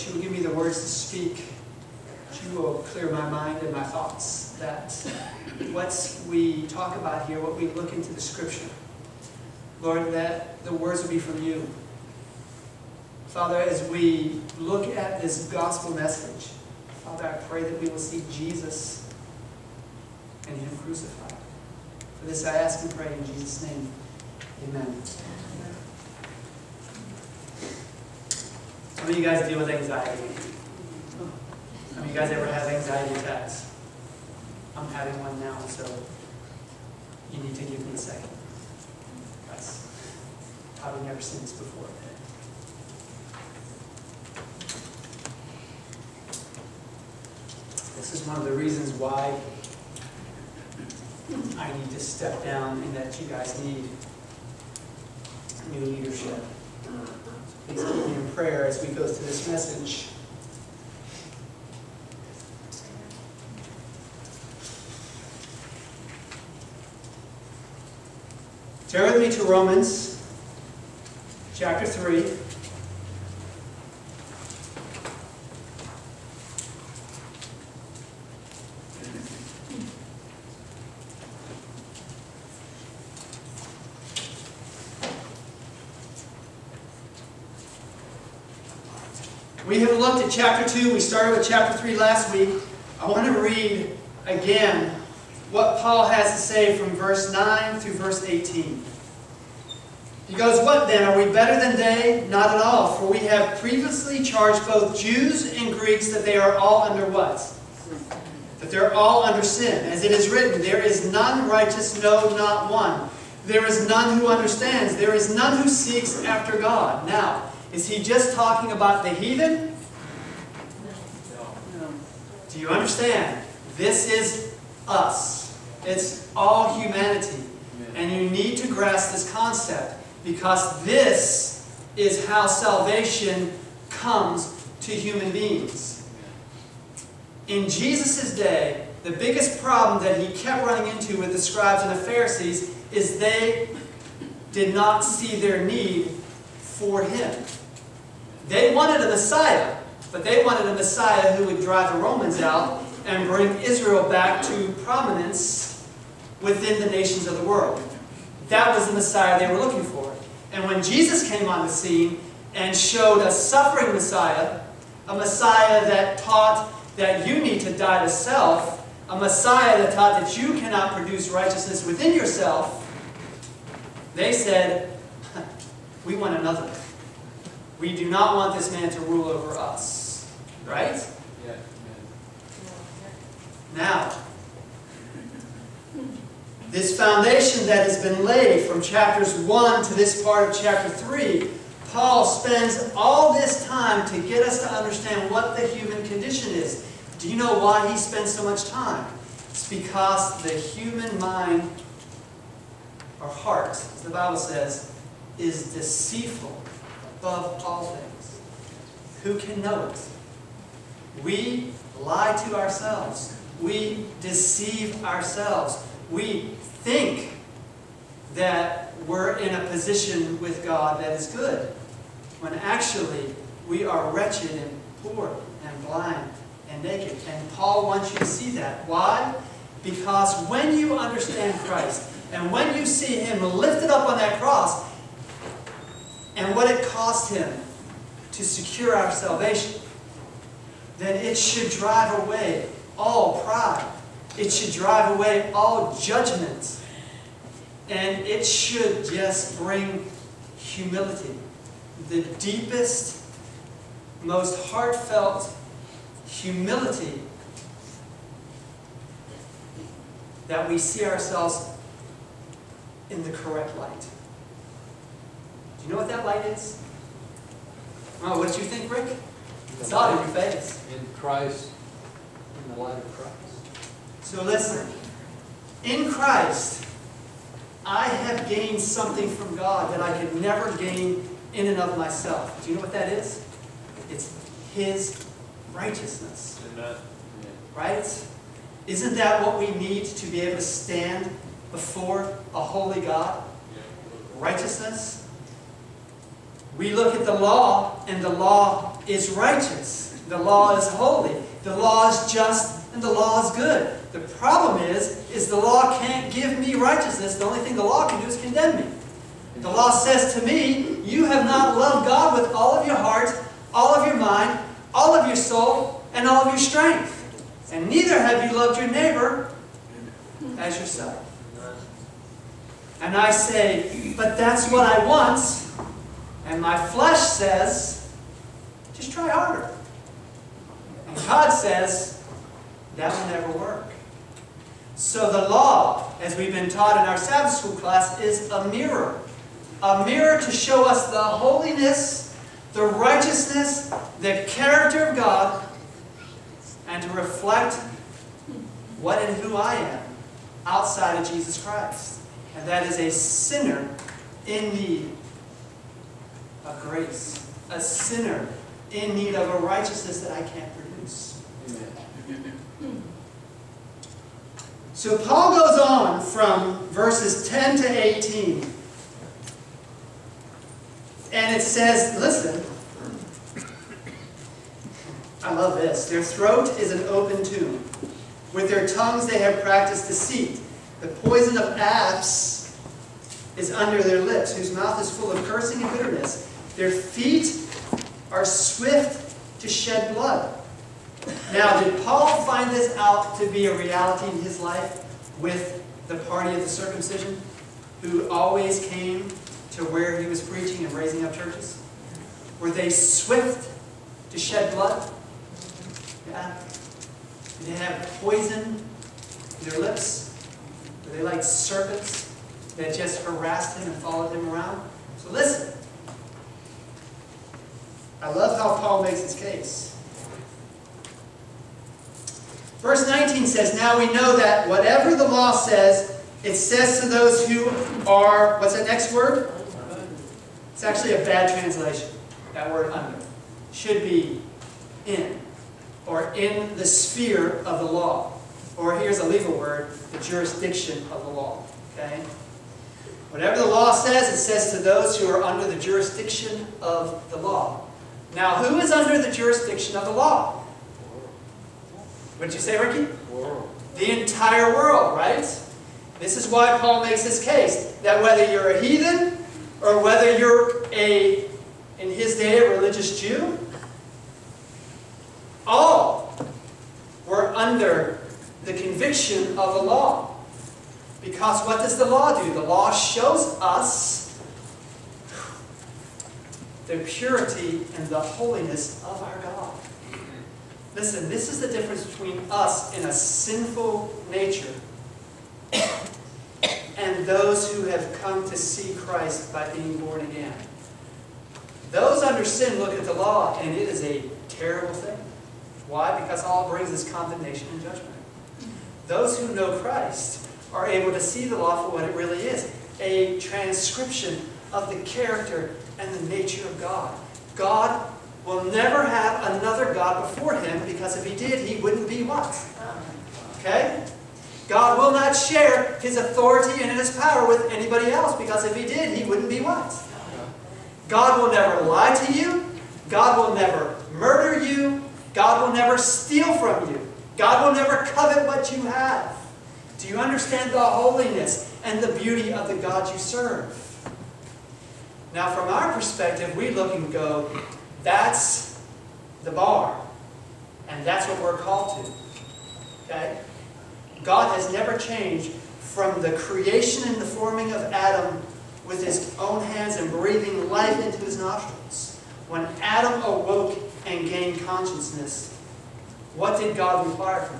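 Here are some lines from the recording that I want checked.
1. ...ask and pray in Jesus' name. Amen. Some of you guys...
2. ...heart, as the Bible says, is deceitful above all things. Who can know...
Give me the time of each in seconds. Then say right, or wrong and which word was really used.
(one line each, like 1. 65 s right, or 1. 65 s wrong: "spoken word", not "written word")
1. 22 s right
2. 203 s right.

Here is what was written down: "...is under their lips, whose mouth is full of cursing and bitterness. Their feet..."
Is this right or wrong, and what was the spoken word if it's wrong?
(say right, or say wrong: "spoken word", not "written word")
right.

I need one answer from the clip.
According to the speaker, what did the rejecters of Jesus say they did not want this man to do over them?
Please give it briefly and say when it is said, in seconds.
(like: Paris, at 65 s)
Rule, at 179 s.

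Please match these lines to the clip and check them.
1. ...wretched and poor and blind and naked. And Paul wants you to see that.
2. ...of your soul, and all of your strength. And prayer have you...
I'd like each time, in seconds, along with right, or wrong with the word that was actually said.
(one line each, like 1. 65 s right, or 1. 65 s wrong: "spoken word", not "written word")
1. 224 s right
2. 315 s wrong: "neither", not "prayer".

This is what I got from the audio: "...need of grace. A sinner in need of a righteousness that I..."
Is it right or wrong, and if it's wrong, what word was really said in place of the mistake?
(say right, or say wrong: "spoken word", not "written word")
right.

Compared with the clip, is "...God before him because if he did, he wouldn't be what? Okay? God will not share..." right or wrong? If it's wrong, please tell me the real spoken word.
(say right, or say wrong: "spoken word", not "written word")
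right.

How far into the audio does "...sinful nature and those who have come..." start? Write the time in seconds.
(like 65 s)
483 s.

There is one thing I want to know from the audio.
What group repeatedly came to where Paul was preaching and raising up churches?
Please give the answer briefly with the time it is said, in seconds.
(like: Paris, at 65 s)
The party of the circumcision, at 396 s.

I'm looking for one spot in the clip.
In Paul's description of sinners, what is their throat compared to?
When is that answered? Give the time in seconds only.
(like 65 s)
376 s.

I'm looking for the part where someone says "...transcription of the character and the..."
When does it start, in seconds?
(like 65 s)
503 s.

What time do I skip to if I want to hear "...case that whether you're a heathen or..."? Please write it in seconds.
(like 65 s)
457 s.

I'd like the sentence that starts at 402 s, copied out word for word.
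Were they swift to shed blood?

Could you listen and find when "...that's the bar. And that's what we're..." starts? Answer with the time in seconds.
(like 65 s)
538 s.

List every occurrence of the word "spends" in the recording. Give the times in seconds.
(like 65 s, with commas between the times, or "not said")
192 s, 197 s.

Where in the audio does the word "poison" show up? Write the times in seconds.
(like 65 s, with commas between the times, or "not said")
381 s, 408 s.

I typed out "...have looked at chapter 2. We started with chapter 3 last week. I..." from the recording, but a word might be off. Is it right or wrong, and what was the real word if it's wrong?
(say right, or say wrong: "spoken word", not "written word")
right.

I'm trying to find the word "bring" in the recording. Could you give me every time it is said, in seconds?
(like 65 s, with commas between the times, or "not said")
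153 s, 249 s, 496 s.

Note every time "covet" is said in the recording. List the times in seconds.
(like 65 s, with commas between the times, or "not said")
528 s.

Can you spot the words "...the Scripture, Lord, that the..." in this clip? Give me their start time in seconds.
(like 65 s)
8 s.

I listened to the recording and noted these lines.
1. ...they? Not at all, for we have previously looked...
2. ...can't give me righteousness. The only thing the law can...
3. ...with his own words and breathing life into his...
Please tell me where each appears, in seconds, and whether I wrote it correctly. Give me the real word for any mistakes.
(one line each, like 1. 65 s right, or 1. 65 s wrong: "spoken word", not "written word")
1. 101 s wrong: "charged", not "looked"
2. 306 s right
3. 548 s wrong: "hands", not "words".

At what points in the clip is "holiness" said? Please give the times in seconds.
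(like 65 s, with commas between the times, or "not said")
341 s, 478 s, 530 s.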